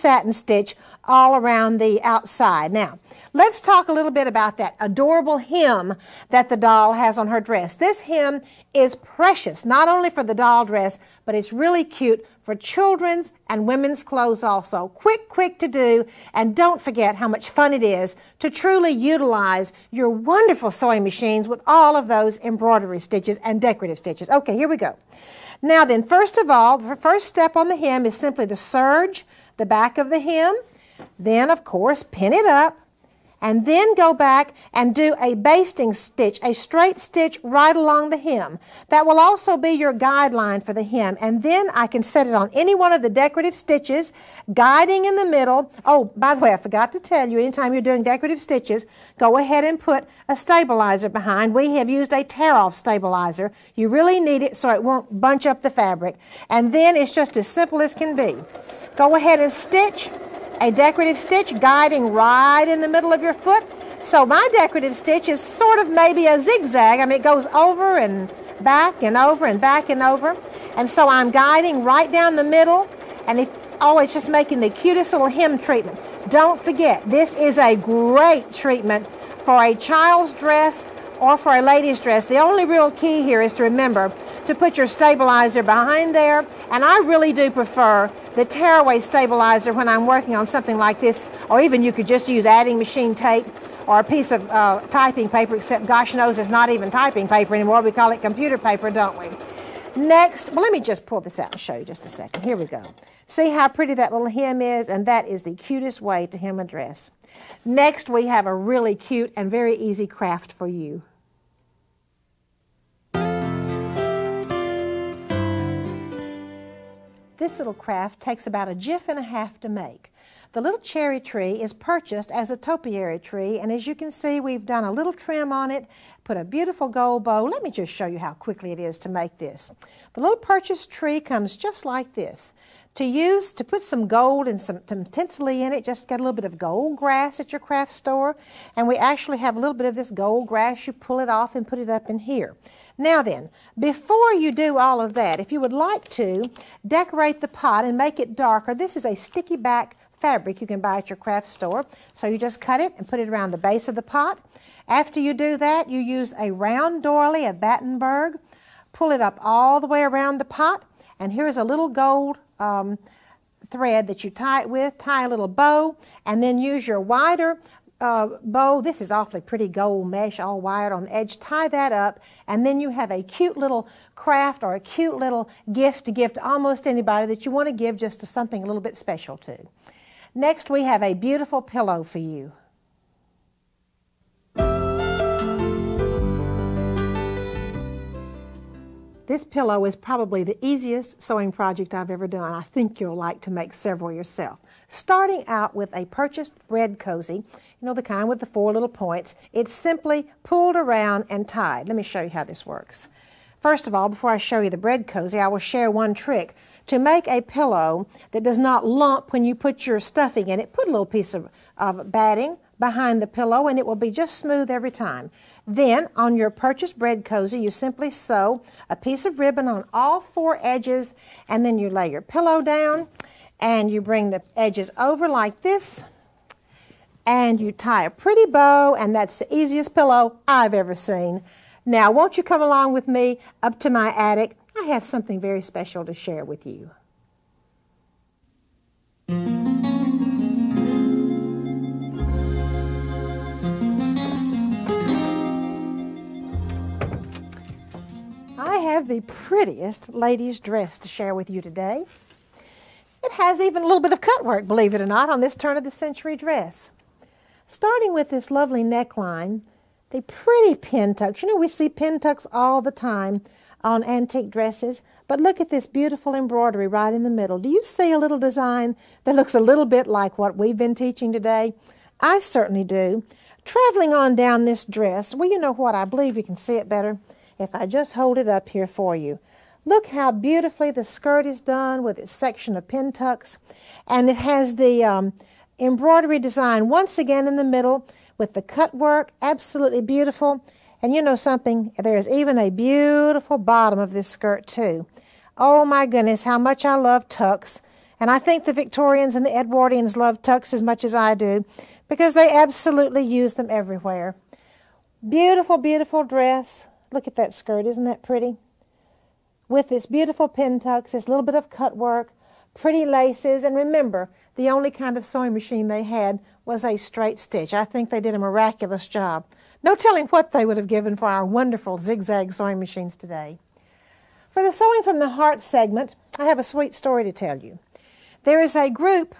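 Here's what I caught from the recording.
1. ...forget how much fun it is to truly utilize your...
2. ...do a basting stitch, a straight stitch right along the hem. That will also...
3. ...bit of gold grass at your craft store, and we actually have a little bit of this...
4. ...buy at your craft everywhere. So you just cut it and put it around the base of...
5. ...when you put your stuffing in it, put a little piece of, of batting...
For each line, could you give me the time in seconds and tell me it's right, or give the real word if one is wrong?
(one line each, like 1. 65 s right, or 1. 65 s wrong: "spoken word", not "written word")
1. 16 s right
2. 34 s right
3. 136 s right
4. 150 s wrong: "store", not "everywhere"
5. 209 s right.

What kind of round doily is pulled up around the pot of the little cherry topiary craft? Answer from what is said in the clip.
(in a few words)
Battenburg.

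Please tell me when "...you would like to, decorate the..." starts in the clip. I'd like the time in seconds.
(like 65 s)
145 s.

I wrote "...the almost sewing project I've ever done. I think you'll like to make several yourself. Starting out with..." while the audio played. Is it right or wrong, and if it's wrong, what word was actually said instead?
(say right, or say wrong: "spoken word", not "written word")
wrong: "easiest", not "almost".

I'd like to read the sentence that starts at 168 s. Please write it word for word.
This is awfully pretty gold mesh, all wired on the edge.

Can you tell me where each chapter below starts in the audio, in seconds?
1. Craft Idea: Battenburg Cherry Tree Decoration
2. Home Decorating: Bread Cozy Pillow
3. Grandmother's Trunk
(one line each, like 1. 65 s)
1. 113 s
2. 184 s
3. 238 s.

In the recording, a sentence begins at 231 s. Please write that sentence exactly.
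Now, won't you come along with me up to my attic?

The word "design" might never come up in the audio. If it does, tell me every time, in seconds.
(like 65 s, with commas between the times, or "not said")
268 s, 286 s.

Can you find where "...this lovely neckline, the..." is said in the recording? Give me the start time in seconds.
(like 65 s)
258 s.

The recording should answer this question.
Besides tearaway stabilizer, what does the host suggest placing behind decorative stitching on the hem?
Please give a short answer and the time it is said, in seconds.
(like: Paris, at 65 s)
Adding machine tape, at 92 s.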